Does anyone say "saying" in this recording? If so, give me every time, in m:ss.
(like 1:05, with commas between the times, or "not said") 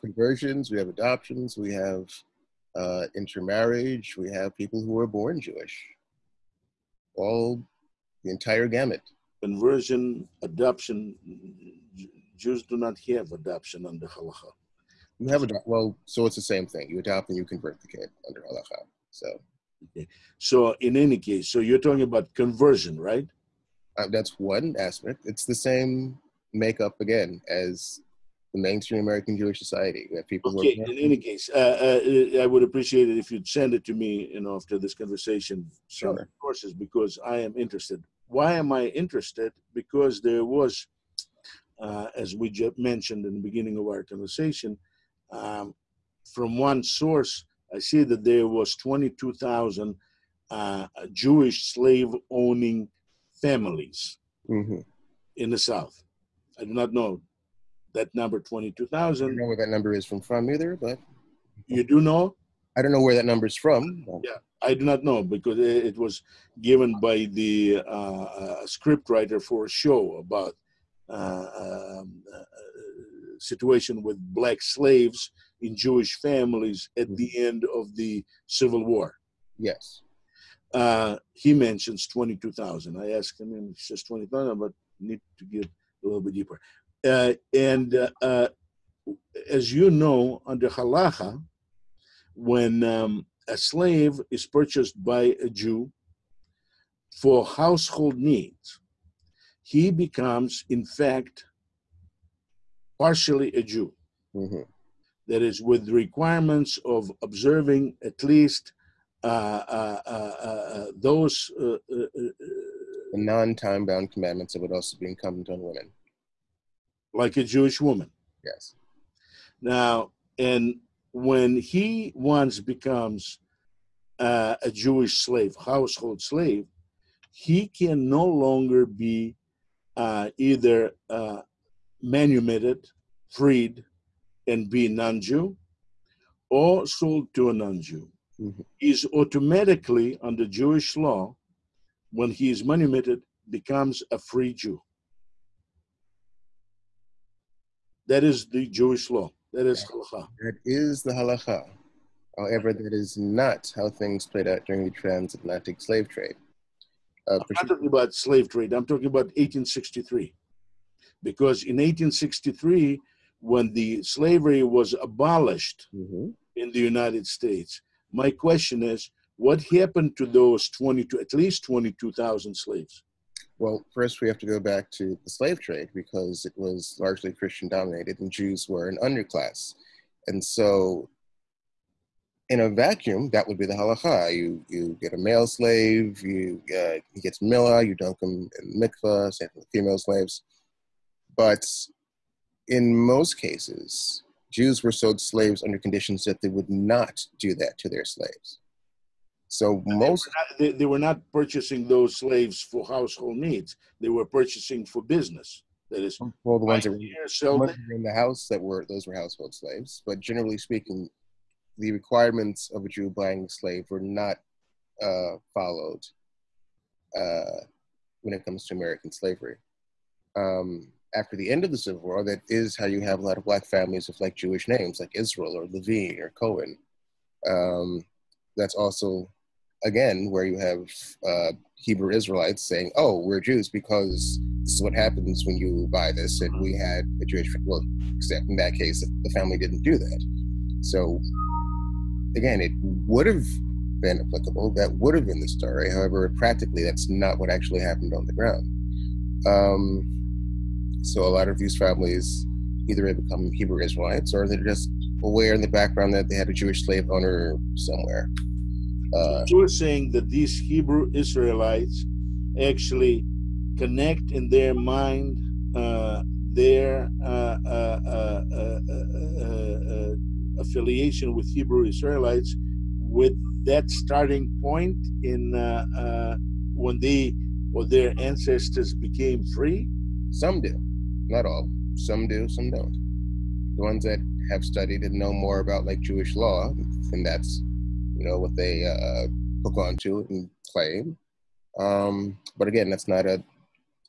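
3:52, 4:19.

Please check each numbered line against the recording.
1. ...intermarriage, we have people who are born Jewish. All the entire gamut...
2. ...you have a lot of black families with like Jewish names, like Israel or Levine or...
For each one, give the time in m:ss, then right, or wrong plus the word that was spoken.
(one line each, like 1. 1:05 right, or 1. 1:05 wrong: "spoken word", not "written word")
1. 0:03 right
2. 3:42 right.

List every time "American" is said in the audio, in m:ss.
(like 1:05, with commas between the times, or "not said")
0:29, 3:38.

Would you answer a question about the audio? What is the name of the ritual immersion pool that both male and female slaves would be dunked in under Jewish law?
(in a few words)
mikvah.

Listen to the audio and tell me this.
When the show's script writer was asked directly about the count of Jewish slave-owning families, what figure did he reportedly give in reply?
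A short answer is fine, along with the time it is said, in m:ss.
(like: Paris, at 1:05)
20,000, at 1:24.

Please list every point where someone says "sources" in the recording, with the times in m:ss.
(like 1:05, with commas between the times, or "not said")
0:36, 0:46.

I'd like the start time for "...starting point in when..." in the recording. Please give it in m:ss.
4:33.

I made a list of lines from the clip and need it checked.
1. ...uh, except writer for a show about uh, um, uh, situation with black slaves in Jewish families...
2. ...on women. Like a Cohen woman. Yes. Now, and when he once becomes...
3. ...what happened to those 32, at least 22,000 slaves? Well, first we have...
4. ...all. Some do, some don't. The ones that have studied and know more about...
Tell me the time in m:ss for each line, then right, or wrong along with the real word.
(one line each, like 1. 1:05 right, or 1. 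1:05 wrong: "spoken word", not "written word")
1. 1:08 wrong: "script", not "except"
2. 1:55 wrong: "Jewish", not "Cohen"
3. 2:49 wrong: "22", not "32"
4. 4:41 right.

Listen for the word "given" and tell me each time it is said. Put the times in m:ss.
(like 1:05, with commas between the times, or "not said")
1:06.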